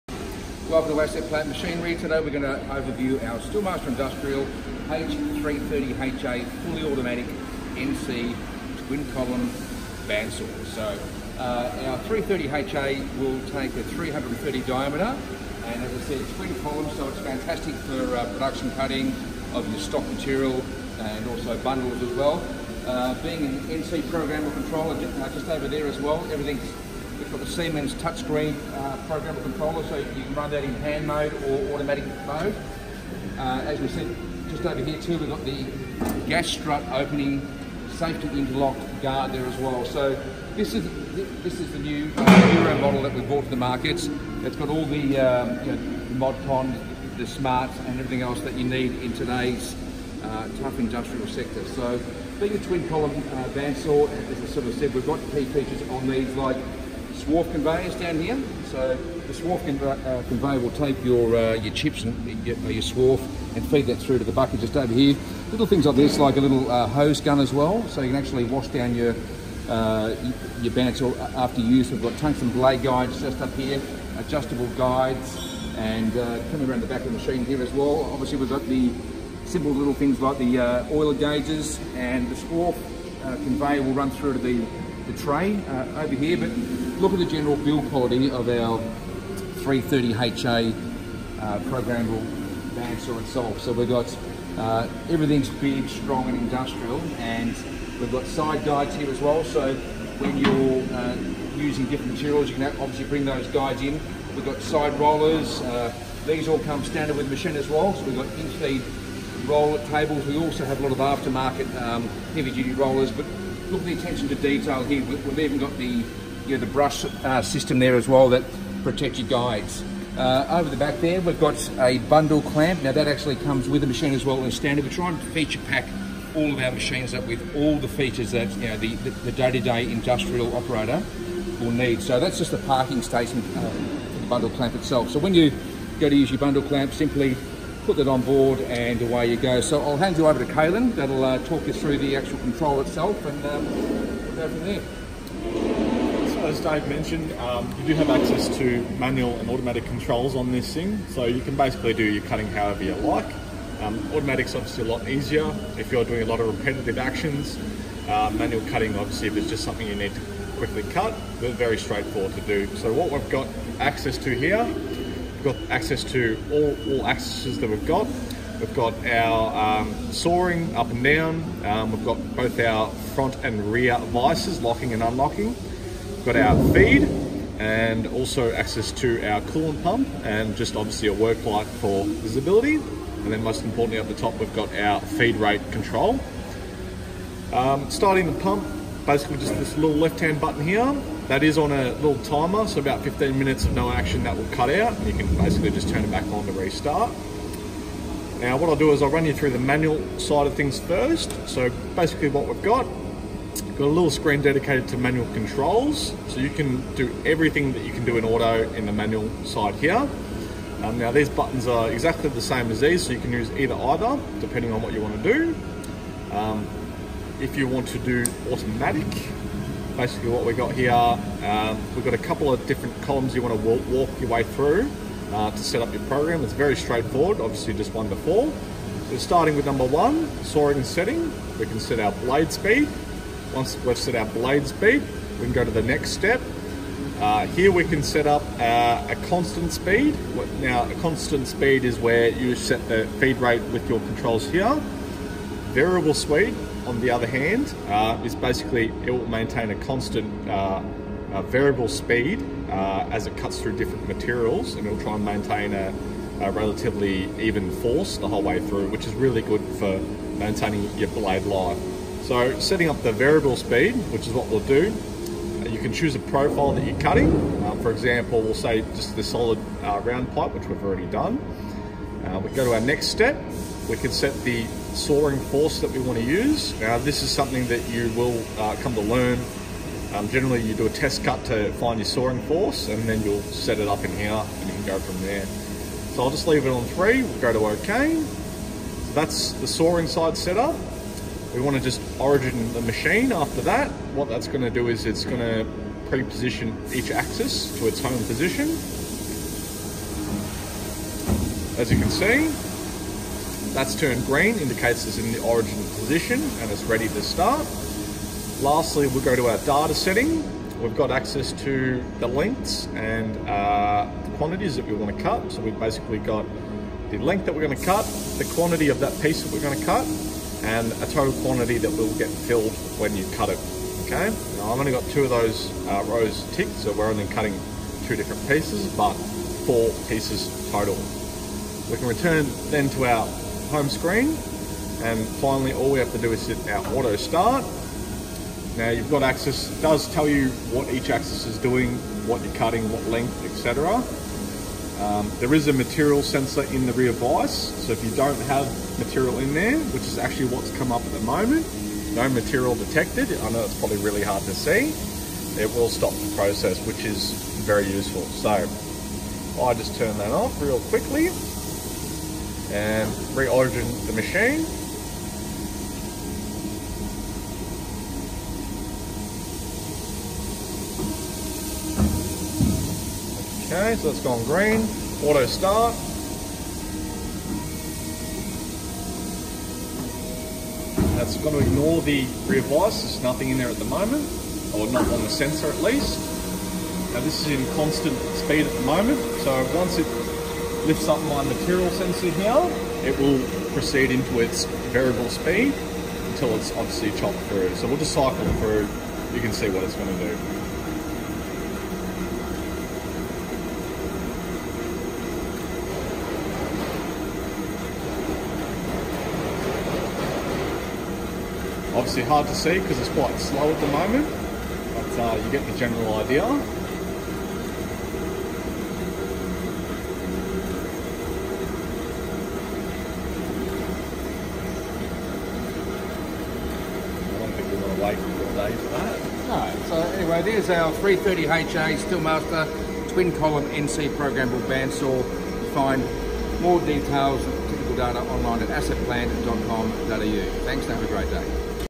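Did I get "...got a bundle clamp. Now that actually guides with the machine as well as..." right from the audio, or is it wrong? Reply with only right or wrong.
wrong.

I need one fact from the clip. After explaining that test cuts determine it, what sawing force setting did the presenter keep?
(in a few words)
3.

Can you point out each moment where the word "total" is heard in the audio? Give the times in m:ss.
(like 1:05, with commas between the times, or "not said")
5:21, 5:30.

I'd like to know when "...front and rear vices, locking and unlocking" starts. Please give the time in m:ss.
2:53.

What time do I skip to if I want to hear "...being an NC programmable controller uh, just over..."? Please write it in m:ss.
0:23.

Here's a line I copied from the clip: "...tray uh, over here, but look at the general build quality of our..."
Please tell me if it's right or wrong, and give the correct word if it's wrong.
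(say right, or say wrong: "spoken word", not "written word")
right.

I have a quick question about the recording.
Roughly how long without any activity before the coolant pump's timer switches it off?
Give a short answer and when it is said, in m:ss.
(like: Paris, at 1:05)
15 minutes, at 3:13.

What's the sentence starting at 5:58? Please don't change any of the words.
So I just turn that off real quickly and re reorigin the machine.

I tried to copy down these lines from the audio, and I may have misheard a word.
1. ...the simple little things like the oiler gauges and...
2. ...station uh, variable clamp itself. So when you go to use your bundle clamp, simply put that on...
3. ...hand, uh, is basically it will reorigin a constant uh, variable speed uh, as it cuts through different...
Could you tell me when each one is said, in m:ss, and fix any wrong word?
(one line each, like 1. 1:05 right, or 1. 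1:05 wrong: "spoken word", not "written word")
1. 1:18 right
2. 2:13 wrong: "bundle", not "variable"
3. 4:07 wrong: "maintain", not "reorigin".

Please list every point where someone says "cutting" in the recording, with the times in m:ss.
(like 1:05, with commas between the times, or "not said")
0:18, 2:32, 2:38, 4:26, 5:27, 5:42.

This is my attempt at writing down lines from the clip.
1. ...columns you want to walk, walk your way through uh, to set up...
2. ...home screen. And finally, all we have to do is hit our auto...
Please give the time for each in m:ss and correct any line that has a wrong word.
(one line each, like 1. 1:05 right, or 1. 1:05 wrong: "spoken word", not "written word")
1. 3:43 right
2. 5:33 right.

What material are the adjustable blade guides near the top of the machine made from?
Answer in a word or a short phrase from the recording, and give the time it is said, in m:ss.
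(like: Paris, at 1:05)
Tungsten, at 1:12.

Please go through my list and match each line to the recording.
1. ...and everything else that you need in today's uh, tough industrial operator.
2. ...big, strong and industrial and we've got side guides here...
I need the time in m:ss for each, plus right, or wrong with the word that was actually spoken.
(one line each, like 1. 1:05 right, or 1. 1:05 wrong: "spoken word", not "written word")
1. 0:47 wrong: "sector", not "operator"
2. 1:35 right.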